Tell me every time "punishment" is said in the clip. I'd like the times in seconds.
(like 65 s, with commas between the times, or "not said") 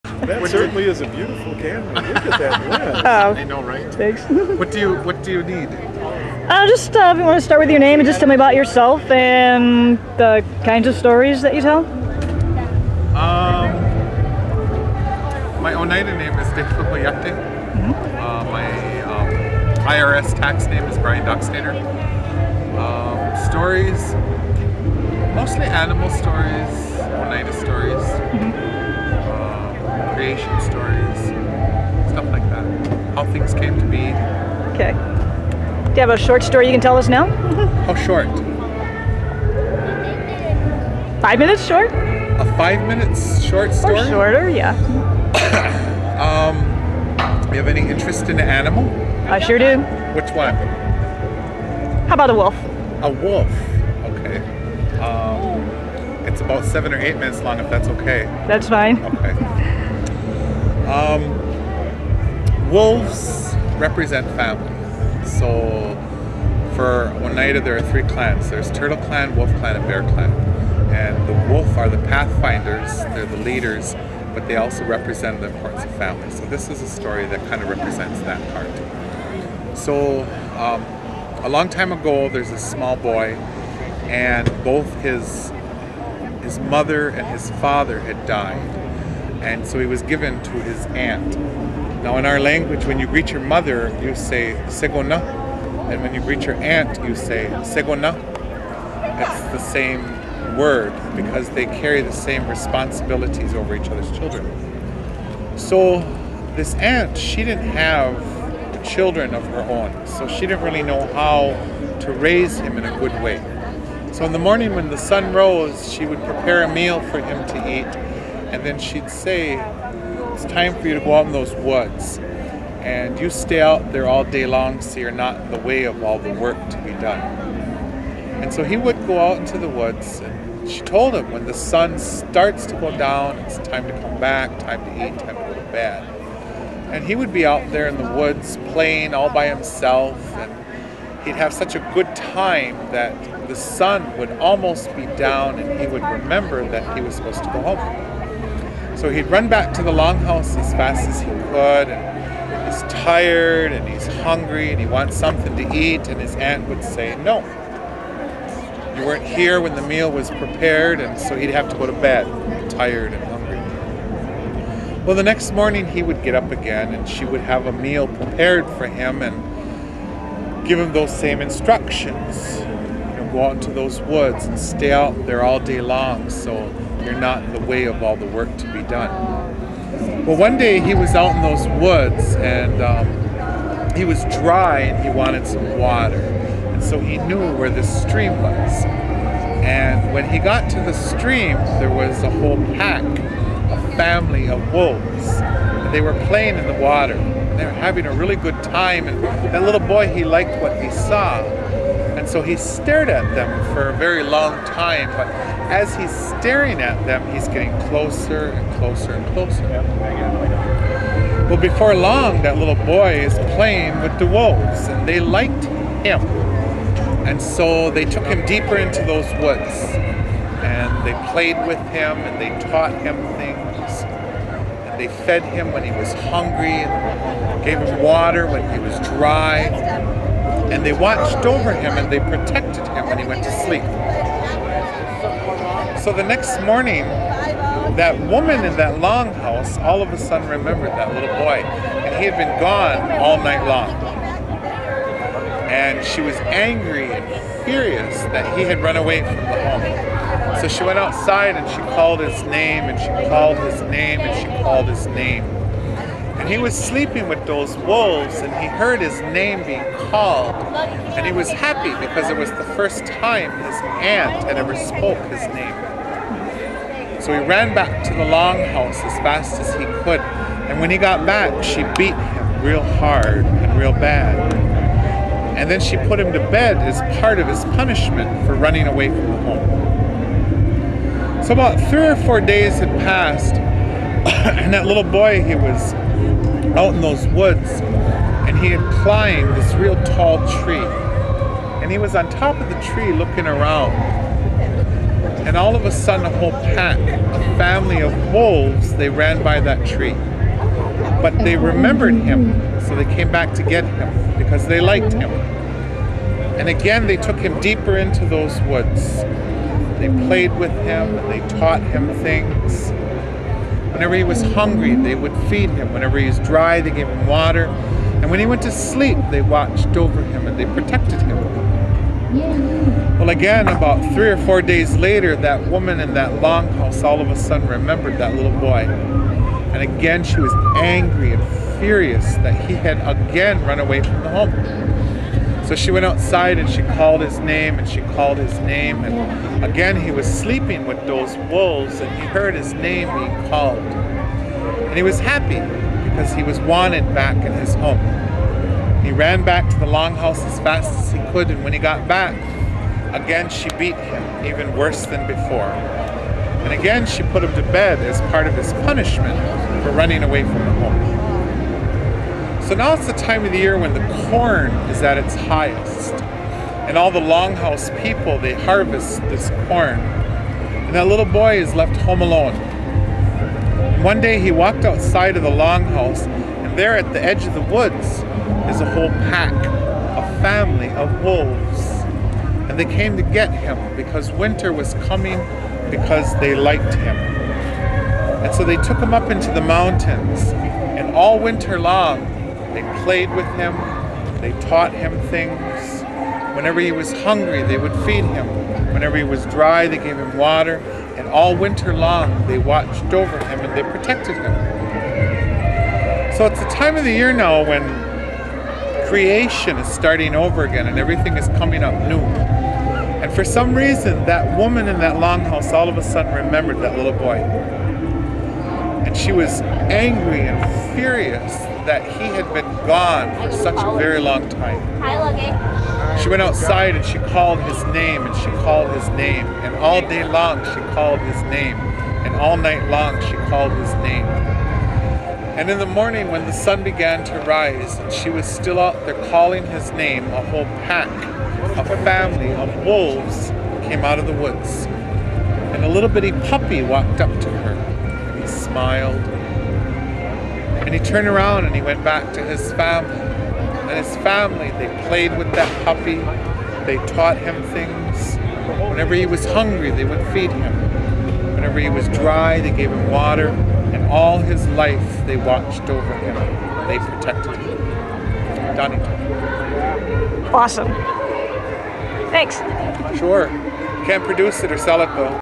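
277 s, 358 s.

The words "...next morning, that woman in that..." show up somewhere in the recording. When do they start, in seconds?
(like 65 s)
236 s.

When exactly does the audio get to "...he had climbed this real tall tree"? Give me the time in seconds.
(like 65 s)
288 s.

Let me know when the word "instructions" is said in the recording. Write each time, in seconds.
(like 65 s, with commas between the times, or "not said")
171 s.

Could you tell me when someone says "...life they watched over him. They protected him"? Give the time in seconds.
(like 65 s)
464 s.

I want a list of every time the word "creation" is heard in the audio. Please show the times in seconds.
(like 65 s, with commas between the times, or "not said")
30 s, 409 s.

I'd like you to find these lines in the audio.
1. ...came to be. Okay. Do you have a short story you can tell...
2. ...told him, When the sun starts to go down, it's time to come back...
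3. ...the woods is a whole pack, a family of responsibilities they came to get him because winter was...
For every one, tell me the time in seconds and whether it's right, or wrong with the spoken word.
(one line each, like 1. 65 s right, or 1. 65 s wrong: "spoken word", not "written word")
1. 33 s right
2. 130 s right
3. 377 s wrong: "wolves", not "responsibilities".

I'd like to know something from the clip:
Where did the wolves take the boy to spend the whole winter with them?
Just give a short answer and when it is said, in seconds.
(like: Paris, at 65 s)
the mountains, at 389 s.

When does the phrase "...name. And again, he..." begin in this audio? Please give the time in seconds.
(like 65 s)
338 s.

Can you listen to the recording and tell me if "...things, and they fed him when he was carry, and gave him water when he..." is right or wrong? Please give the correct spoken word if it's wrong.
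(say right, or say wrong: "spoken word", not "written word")
wrong: "hungry", not "carry".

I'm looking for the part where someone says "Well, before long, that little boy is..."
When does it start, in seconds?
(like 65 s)
211 s.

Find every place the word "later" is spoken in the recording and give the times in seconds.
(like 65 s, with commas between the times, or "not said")
324 s.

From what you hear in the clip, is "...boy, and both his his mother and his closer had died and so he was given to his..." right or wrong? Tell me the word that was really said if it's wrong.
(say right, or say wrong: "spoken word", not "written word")
wrong: "father", not "closer".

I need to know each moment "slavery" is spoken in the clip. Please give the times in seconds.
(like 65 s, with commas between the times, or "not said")
not said.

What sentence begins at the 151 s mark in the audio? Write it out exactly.
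And he's tired and he's hungry and he wants something to eat.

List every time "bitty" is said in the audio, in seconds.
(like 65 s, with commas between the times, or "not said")
446 s.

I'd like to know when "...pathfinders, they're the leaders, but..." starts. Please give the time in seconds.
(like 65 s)
72 s.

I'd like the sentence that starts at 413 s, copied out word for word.
And for some reason, that woman in that longhouse all of a sudden remembered that little boy.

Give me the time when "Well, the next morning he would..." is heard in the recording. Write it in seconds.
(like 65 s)
165 s.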